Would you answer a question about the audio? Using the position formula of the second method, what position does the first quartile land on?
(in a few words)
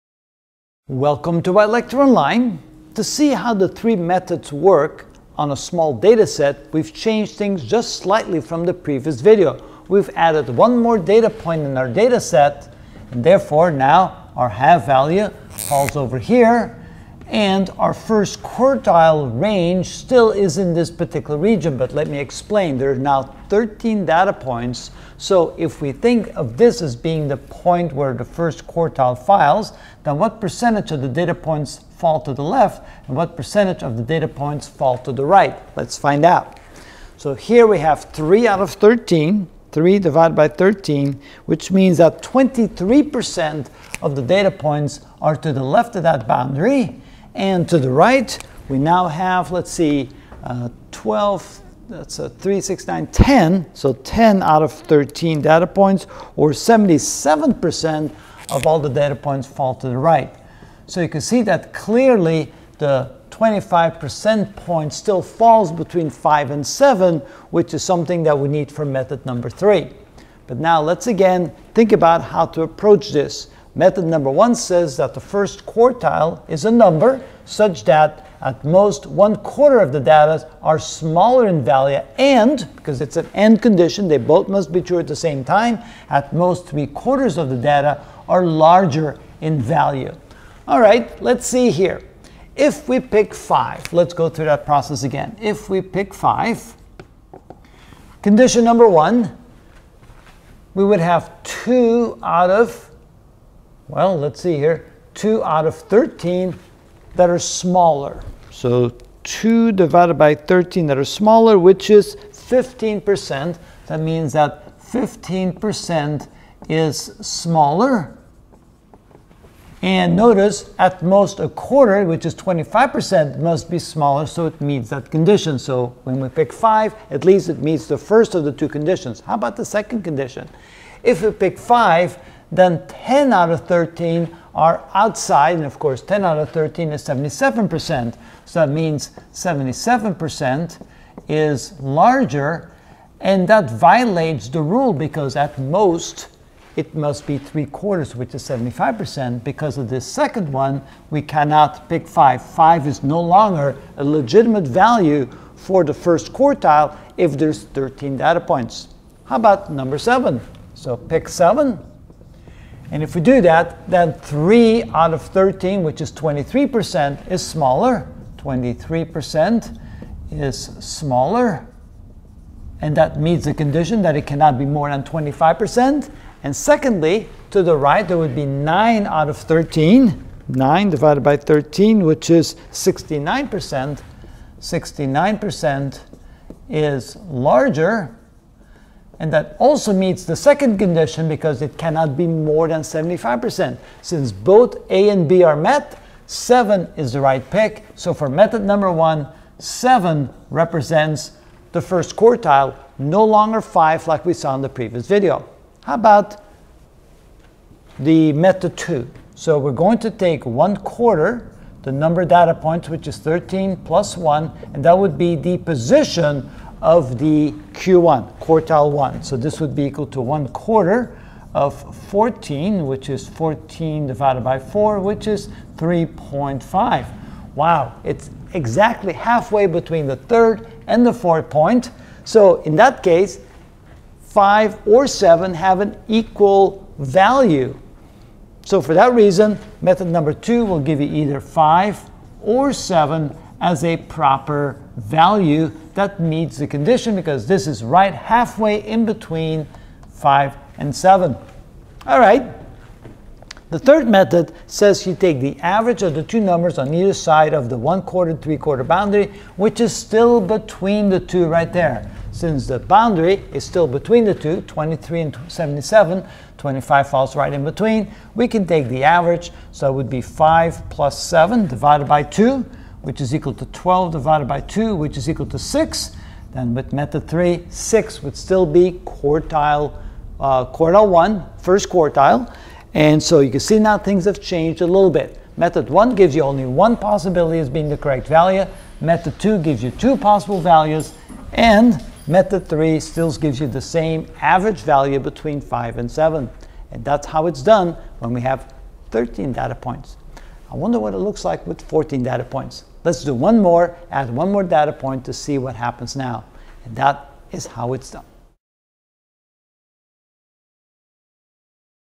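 3.5.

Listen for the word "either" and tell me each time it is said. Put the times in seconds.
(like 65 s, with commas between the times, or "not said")
241 s, 256 s.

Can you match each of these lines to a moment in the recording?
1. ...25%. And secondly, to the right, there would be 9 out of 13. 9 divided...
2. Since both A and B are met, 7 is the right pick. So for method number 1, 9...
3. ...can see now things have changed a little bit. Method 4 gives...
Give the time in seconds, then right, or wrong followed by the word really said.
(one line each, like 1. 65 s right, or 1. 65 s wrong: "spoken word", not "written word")
1. 175 s right
2. 194 s wrong: "7", not "9"
3. 283 s wrong: "1", not "4".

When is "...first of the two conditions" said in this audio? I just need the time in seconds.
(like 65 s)
127 s.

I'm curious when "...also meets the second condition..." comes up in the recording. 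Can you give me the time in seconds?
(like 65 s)
189 s.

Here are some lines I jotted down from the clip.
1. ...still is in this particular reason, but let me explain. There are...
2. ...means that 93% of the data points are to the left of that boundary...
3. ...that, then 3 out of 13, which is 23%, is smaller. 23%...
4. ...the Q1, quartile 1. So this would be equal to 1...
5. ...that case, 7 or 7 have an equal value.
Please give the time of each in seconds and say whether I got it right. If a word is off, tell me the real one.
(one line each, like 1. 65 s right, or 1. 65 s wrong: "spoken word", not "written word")
1. 19 s wrong: "region", not "reason"
2. 41 s wrong: "23", not "93"
3. 163 s right
4. 217 s right
5. 232 s wrong: "5", not "7".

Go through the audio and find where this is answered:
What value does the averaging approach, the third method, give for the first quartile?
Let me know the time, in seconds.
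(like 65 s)
275 s.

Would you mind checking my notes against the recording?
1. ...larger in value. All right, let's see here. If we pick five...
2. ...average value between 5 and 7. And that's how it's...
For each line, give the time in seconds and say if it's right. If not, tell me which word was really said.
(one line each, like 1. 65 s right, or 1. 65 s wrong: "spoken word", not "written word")
1. 88 s right
2. 294 s right.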